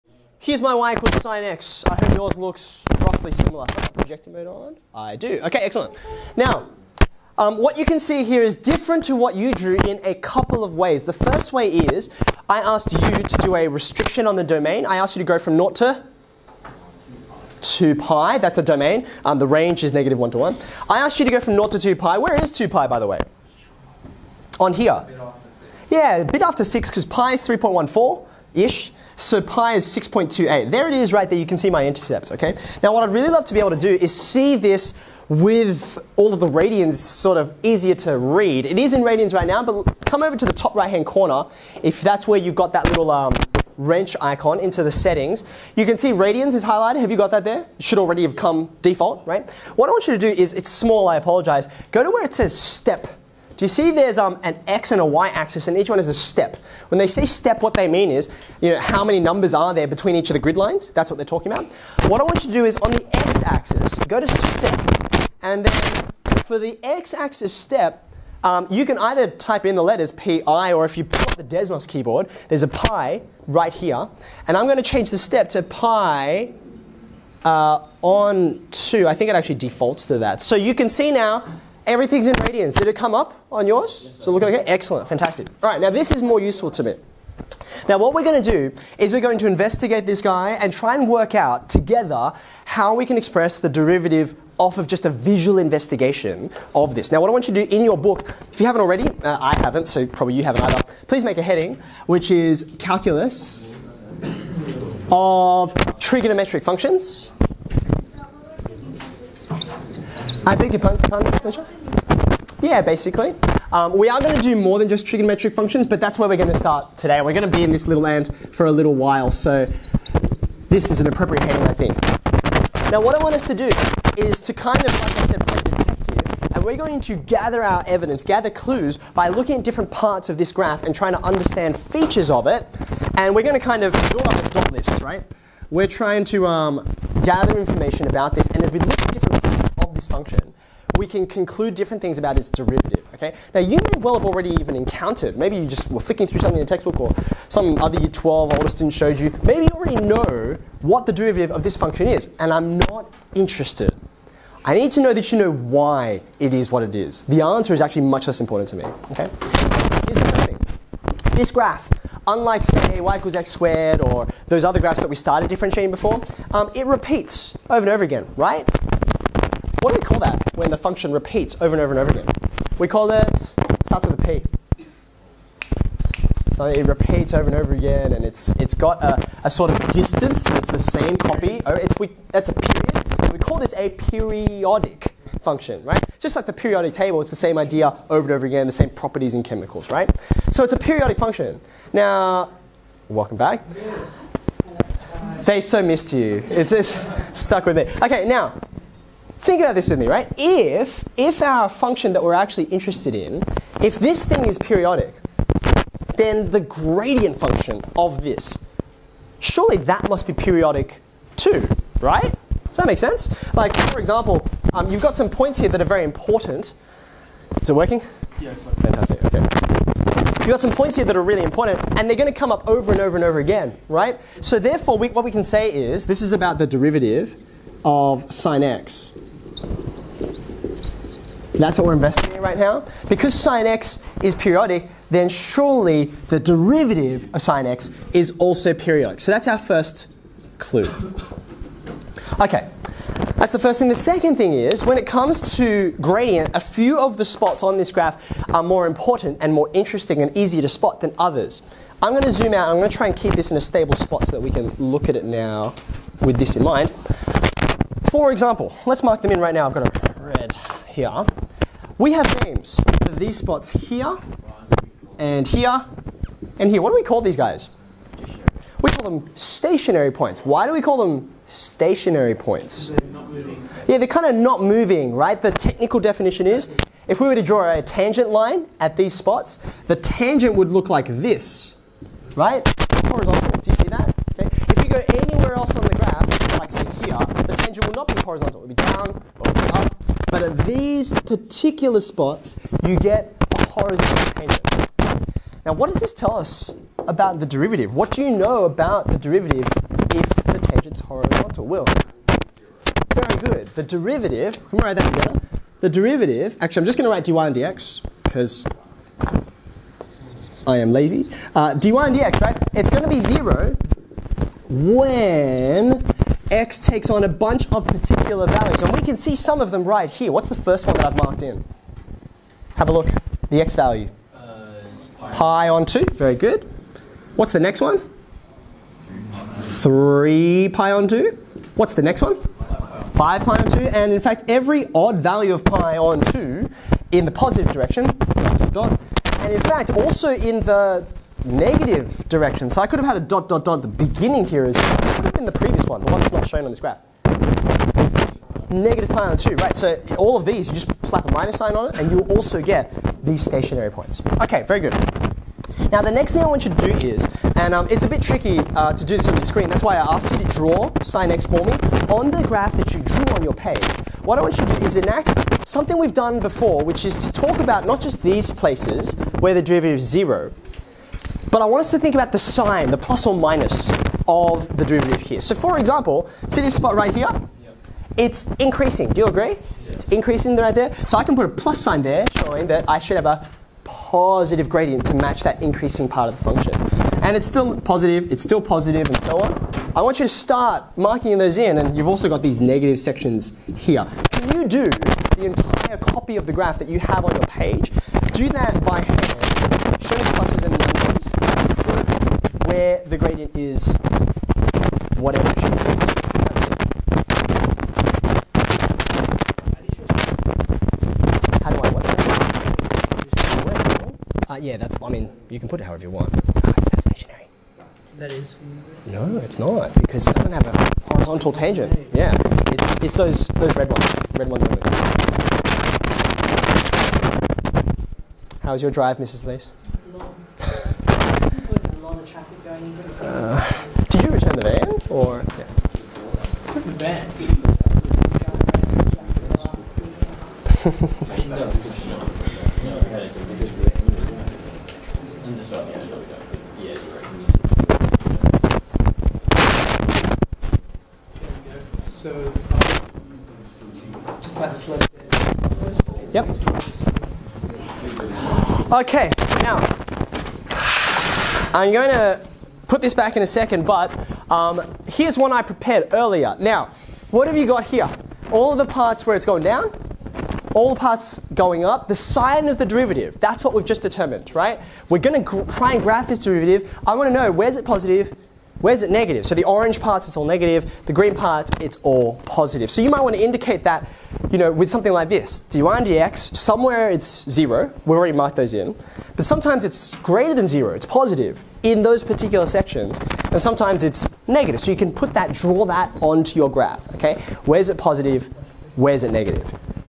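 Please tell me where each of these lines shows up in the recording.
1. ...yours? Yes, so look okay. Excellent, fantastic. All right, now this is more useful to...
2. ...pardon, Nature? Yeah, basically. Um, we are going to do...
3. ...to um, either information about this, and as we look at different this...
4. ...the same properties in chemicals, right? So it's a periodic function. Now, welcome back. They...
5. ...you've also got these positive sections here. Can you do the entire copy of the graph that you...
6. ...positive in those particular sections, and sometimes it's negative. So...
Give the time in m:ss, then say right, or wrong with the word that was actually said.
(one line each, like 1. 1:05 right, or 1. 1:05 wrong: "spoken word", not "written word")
1. 1:23 right
2. 1:50 right
3. 2:16 wrong: "gather", not "either"
4. 3:08 right
5. 6:31 wrong: "negative", not "positive"
6. 8:11 right.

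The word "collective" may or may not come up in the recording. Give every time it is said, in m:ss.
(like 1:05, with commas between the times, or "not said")
not said.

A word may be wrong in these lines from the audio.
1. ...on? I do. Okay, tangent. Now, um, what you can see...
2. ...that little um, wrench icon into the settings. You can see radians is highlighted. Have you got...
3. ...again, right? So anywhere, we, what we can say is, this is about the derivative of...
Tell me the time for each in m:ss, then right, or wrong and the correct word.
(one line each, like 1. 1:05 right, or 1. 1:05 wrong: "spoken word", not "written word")
1. 0:04 wrong: "excellent", not "tangent"
2. 0:42 right
3. 3:43 wrong: "therefore", not "anywhere".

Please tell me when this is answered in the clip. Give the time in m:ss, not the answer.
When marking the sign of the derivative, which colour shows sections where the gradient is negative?
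7:59.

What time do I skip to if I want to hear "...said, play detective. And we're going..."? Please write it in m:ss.
2:05.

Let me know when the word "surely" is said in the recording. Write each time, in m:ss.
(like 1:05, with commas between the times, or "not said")
3:29, 3:55.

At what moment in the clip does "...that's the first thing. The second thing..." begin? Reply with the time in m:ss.
4:03.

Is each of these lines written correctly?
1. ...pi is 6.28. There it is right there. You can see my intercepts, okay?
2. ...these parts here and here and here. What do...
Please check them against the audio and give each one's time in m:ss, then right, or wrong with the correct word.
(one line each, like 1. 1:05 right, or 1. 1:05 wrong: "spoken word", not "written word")
1. 0:29 right
2. 4:23 wrong: "spots", not "parts".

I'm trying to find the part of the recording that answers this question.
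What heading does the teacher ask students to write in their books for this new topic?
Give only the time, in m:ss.
1:42.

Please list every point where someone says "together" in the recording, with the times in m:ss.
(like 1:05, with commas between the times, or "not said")
1:31, 5:05.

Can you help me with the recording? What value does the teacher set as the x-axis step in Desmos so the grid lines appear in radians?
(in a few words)
pi on 2.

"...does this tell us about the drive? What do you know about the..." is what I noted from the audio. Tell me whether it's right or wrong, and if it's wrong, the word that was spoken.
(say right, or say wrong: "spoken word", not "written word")
wrong: "derivative", not "drive".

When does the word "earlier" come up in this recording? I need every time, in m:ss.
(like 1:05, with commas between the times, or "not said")
7:46.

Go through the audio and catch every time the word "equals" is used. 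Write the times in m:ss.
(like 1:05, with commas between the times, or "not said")
0:00, 2:43.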